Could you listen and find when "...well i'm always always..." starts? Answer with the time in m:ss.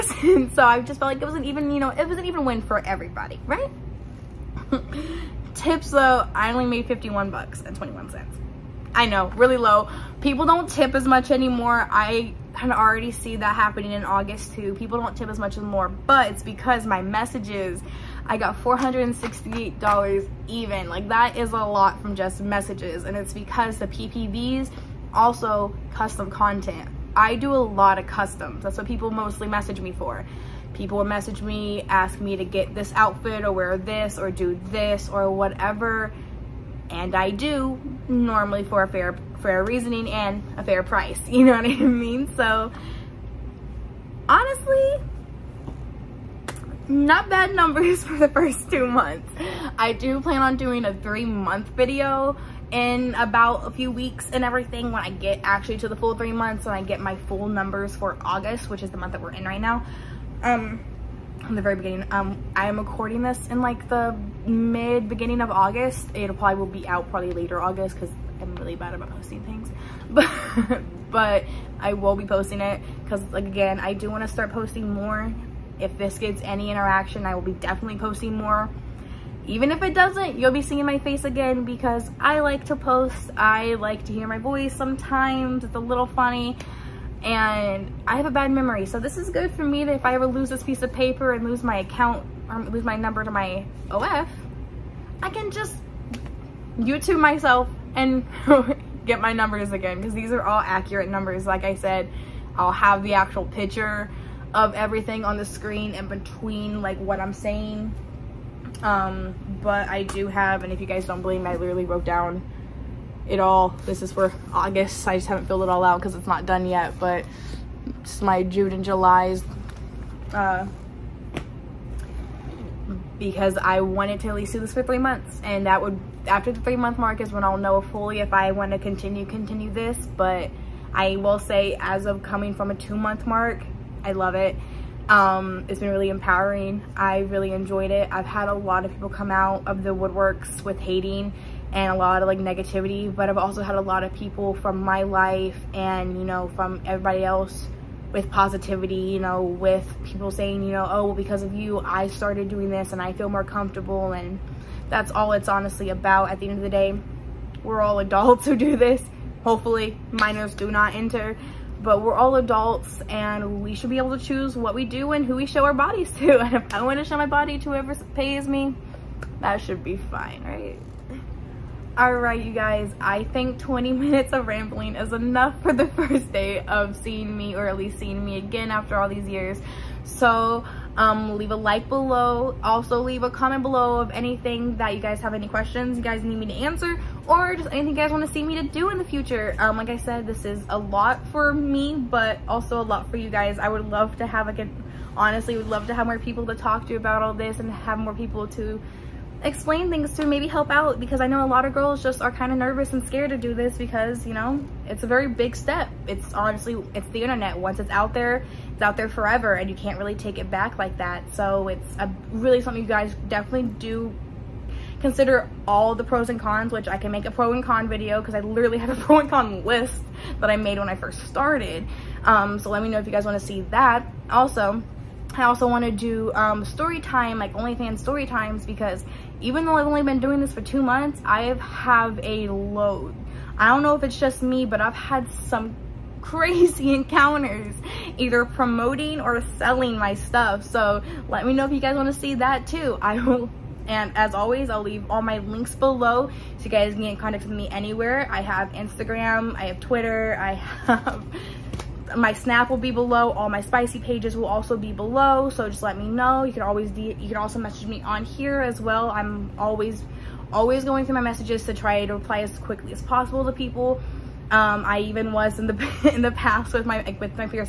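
4:18.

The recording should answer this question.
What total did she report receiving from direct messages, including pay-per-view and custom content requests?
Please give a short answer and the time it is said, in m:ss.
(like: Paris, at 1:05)
$468, at 0:18.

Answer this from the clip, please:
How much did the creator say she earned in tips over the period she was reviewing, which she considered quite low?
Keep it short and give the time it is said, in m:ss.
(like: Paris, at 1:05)
$51.21, at 0:06.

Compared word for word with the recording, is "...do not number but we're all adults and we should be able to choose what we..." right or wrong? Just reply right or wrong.
wrong.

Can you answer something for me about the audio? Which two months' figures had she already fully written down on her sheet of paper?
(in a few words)
June and July.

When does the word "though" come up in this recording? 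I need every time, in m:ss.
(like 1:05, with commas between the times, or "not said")
0:05, 3:49.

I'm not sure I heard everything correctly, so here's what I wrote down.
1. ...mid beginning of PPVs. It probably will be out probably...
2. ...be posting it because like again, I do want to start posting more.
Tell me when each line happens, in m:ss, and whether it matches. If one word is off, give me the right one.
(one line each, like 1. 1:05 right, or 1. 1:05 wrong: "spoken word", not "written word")
1. 1:04 wrong: "August", not "PPVs"
2. 1:12 right.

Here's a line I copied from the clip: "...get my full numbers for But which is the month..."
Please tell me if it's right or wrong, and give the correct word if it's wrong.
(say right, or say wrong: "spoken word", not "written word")
wrong: "August", not "But".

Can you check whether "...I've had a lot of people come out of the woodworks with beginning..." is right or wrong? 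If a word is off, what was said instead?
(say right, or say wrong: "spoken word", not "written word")
wrong: "hating", not "beginning".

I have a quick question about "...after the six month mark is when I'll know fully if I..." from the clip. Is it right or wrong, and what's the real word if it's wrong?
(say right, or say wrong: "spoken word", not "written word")
wrong: "three", not "six".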